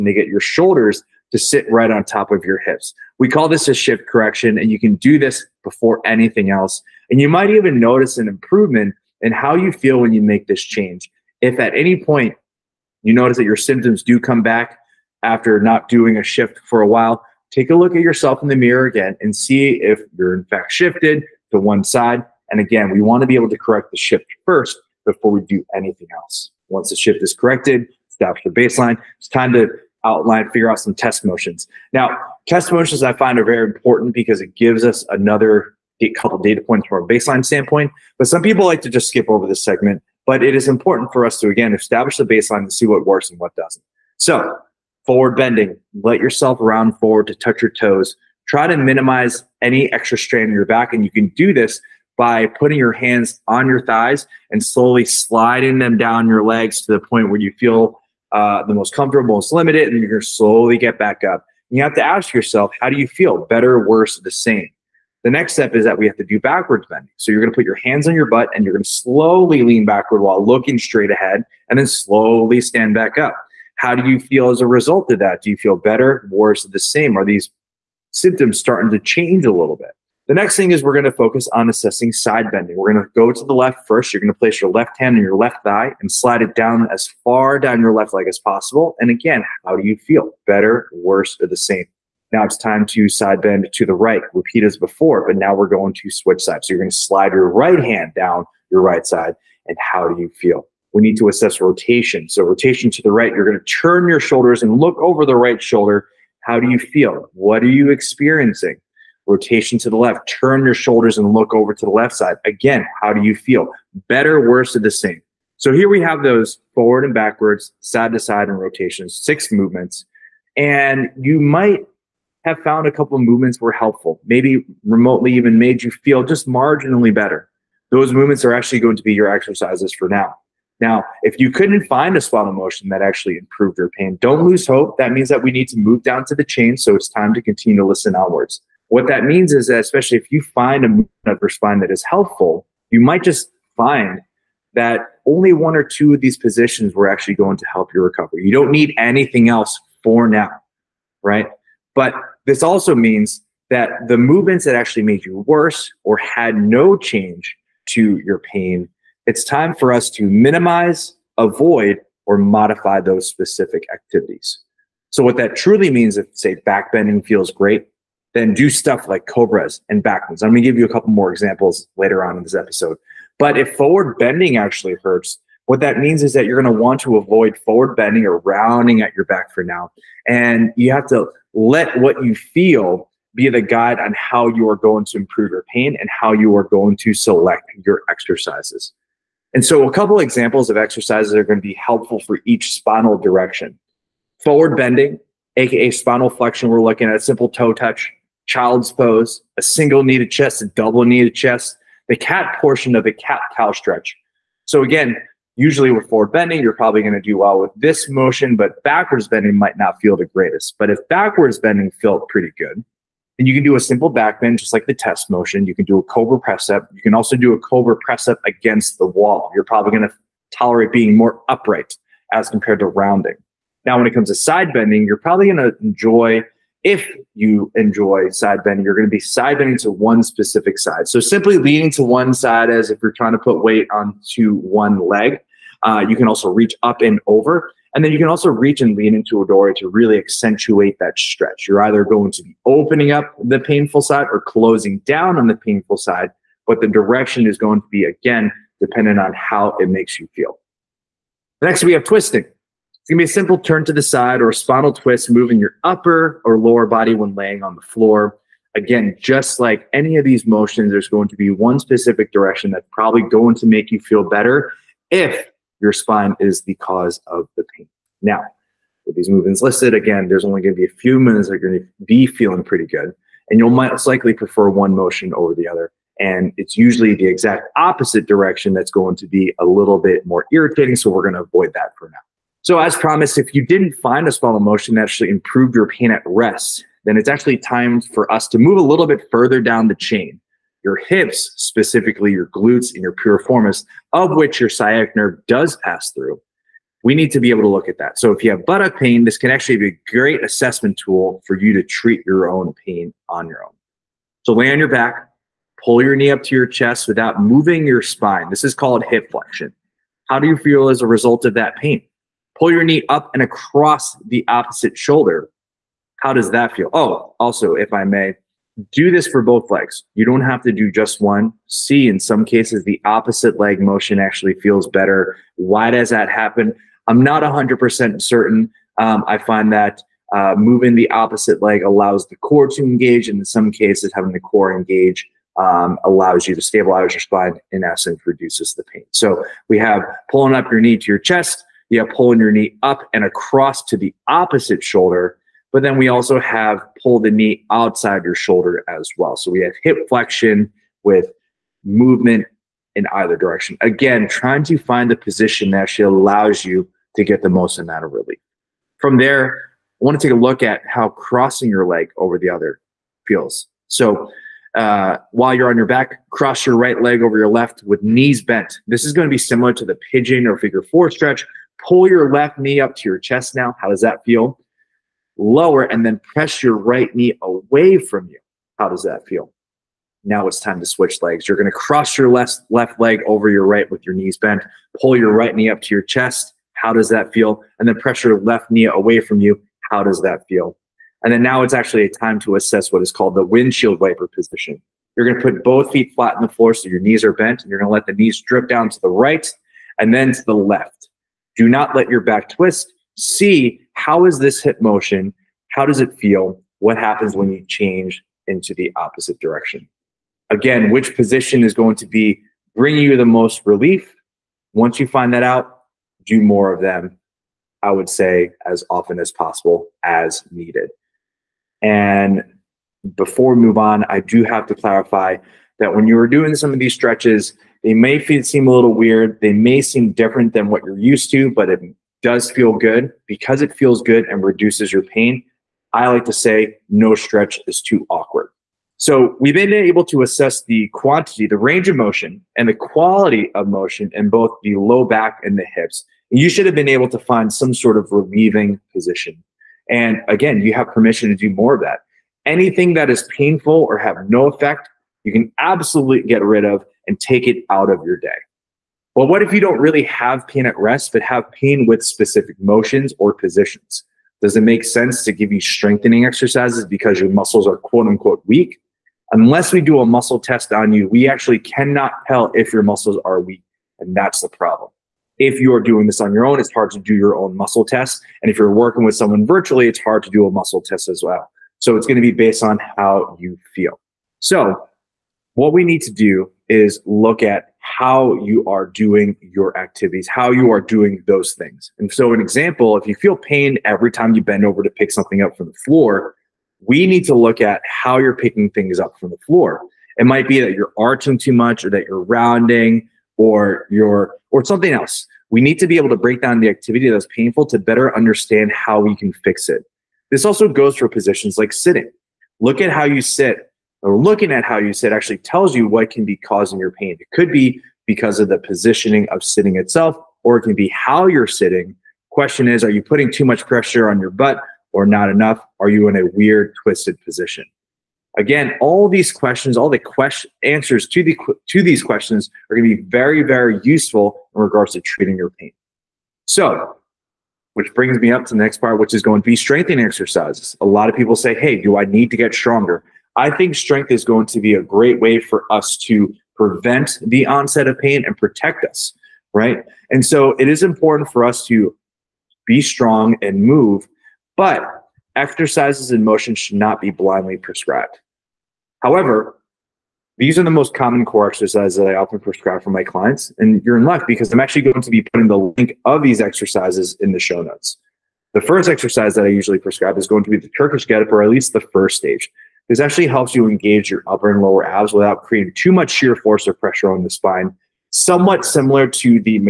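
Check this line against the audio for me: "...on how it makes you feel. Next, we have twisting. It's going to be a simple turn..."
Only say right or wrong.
right.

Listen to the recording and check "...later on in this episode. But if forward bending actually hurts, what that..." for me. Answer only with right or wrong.
right.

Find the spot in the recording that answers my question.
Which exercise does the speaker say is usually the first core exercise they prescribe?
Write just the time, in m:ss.
9:30.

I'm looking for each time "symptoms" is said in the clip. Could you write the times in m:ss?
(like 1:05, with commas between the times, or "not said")
0:13, 1:18.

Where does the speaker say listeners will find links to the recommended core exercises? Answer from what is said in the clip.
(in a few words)
Show notes.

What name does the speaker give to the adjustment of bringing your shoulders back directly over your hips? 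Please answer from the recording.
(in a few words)
Shift correction.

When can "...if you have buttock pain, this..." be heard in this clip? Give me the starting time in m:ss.
4:58.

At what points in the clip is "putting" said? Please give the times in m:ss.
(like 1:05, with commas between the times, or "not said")
0:52, 8:43, 9:25.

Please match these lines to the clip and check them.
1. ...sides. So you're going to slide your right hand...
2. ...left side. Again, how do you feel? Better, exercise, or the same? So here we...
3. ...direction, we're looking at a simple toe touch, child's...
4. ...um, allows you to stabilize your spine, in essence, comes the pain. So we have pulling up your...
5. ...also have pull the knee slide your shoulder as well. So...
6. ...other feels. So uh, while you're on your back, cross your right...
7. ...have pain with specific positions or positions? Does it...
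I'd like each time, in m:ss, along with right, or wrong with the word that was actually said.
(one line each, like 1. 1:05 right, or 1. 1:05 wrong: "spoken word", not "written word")
1. 1:36 right
2. 1:51 wrong: "worse", not "exercise"
3. 3:16 wrong: "flexion", not "direction"
4. 5:35 wrong: "reduces", not "comes"
5. 5:46 wrong: "outside", not "slide"
6. 6:02 right
7. 7:41 wrong: "motions", not "positions".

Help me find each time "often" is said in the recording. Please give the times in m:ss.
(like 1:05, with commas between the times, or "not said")
6:58, 9:22.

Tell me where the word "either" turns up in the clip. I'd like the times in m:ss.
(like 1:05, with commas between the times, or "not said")
4:01, 5:53.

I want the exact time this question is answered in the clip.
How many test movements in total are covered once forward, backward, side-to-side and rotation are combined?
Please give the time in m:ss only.
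1:59.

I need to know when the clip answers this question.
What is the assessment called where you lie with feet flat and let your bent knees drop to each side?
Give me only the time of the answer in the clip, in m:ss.
6:33.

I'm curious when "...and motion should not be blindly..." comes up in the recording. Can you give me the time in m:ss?
9:16.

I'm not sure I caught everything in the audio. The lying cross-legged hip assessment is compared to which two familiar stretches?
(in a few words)
Pigeon or figure four.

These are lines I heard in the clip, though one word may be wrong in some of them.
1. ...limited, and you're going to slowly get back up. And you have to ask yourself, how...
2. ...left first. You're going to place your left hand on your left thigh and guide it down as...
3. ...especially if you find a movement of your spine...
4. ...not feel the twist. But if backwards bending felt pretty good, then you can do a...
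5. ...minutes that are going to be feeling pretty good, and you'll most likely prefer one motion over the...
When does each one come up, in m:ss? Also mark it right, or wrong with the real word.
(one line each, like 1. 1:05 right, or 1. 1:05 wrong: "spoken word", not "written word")
1. 0:59 right
2. 1:23 wrong: "slide", not "guide"
3. 2:19 right
4. 3:29 wrong: "greatest", not "twist"
5. 4:31 right.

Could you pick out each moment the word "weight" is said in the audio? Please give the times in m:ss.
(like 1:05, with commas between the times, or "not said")
3:53.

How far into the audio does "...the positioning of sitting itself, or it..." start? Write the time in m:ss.
8:38.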